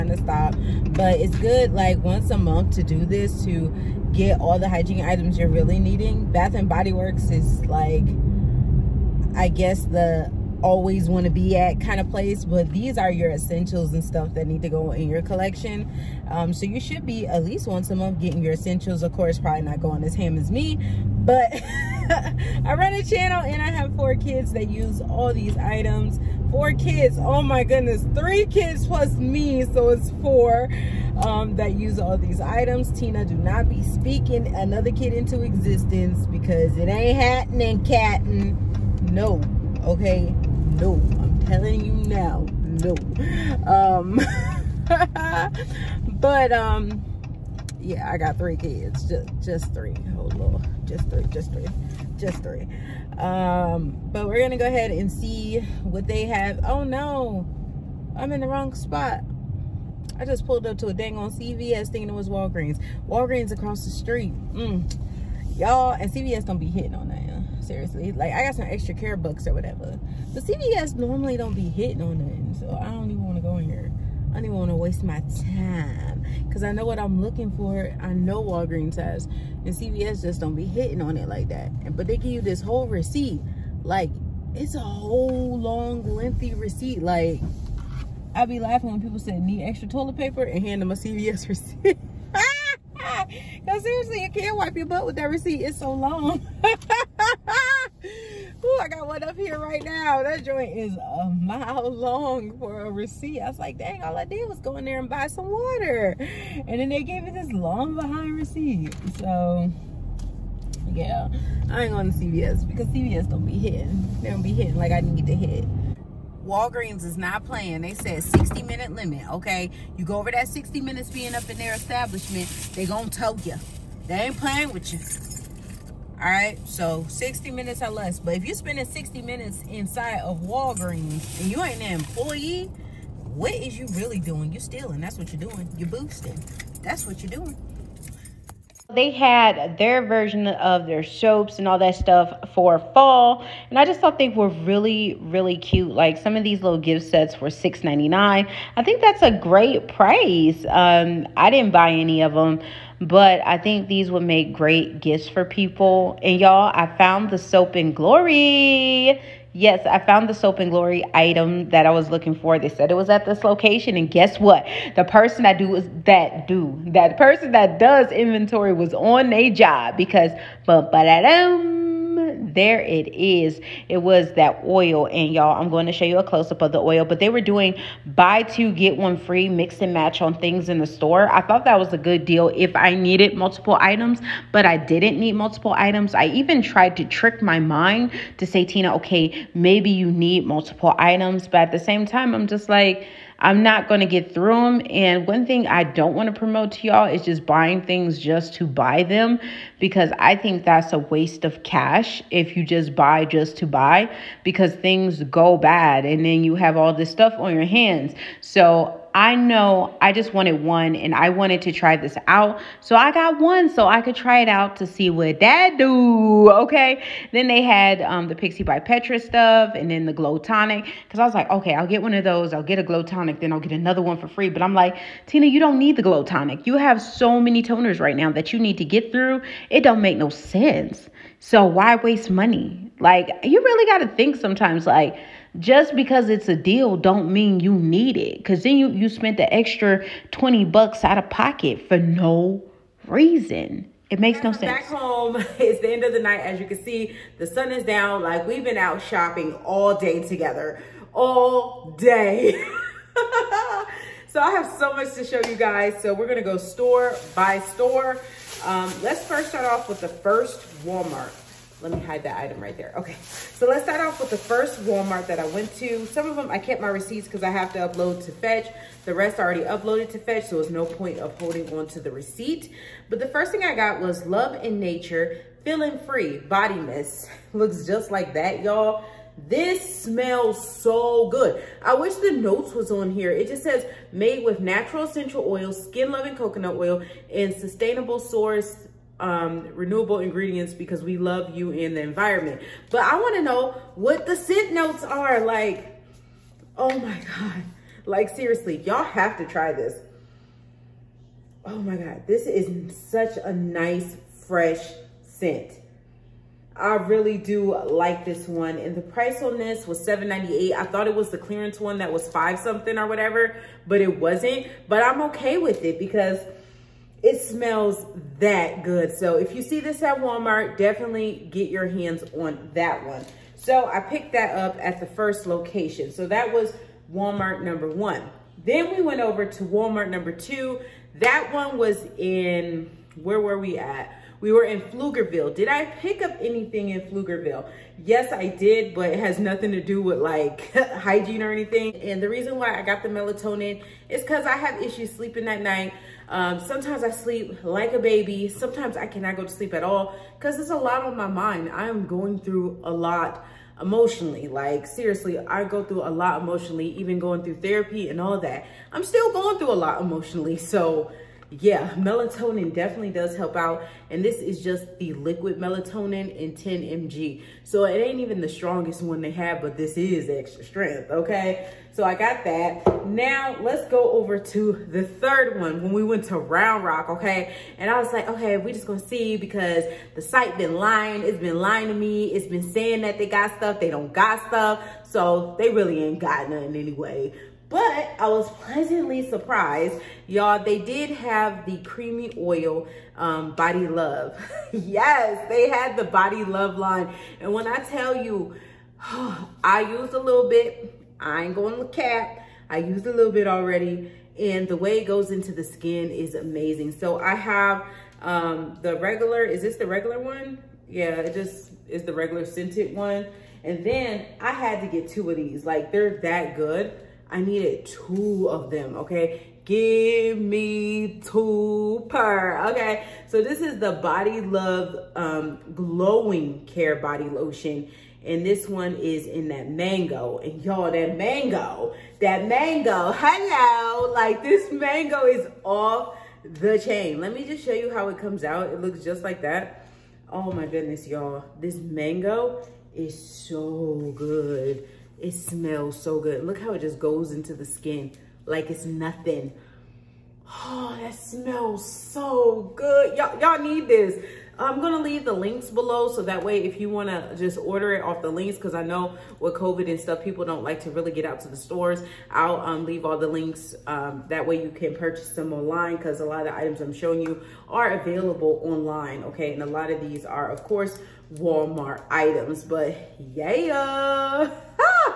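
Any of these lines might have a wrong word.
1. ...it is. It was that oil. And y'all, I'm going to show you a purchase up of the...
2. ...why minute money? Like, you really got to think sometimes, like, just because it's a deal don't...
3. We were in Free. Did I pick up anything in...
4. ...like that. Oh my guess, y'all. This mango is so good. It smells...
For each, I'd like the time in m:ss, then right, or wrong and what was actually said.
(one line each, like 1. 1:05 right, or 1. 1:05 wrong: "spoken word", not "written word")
1. 2:52 wrong: "close", not "purchase"
2. 3:51 wrong: "waste", not "minute"
3. 5:34 wrong: "Pflugerville", not "Free"
4. 7:19 wrong: "goodness", not "guess".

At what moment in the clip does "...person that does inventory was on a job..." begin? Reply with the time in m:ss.
2:47.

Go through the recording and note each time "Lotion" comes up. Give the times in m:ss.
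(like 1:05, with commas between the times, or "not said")
7:07.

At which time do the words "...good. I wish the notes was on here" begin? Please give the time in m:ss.
4:41.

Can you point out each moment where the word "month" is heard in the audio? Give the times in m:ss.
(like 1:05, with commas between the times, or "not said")
0:02, 0:17.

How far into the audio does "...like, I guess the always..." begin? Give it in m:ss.
0:07.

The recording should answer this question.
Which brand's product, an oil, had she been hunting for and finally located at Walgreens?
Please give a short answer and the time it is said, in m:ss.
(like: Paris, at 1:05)
Soap and Glory, at 2:37.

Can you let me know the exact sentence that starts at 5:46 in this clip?
Um, sometimes I sleep like a baby.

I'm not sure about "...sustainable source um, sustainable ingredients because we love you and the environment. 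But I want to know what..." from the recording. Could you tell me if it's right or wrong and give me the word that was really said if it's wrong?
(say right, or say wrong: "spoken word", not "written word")
wrong: "renewable", not "sustainable".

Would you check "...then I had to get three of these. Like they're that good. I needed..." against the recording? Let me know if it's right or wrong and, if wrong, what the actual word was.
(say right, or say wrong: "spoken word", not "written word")
wrong: "two", not "three".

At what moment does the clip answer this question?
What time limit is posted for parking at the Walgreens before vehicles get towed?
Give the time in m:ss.
1:58.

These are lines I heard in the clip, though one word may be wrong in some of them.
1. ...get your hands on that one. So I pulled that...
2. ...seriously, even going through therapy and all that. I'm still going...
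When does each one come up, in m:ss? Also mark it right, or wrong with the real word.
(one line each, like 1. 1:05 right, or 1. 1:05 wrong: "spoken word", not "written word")
1. 5:21 wrong: "picked", not "pulled"
2. 5:56 wrong: "emotionally", not "seriously".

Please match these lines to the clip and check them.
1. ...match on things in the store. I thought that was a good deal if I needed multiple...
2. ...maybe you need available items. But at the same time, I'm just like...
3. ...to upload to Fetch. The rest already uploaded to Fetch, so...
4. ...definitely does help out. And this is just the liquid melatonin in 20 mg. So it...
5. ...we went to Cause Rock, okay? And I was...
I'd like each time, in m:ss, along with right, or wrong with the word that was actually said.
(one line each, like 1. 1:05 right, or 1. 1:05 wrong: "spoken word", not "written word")
1. 2:59 right
2. 3:09 wrong: "multiple", not "available"
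3. 4:27 right
4. 6:02 wrong: "10", not "20"
5. 6:15 wrong: "Round", not "Cause".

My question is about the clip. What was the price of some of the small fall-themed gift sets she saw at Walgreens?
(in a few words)
$6.99.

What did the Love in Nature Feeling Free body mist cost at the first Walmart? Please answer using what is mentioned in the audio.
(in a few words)
$7.98.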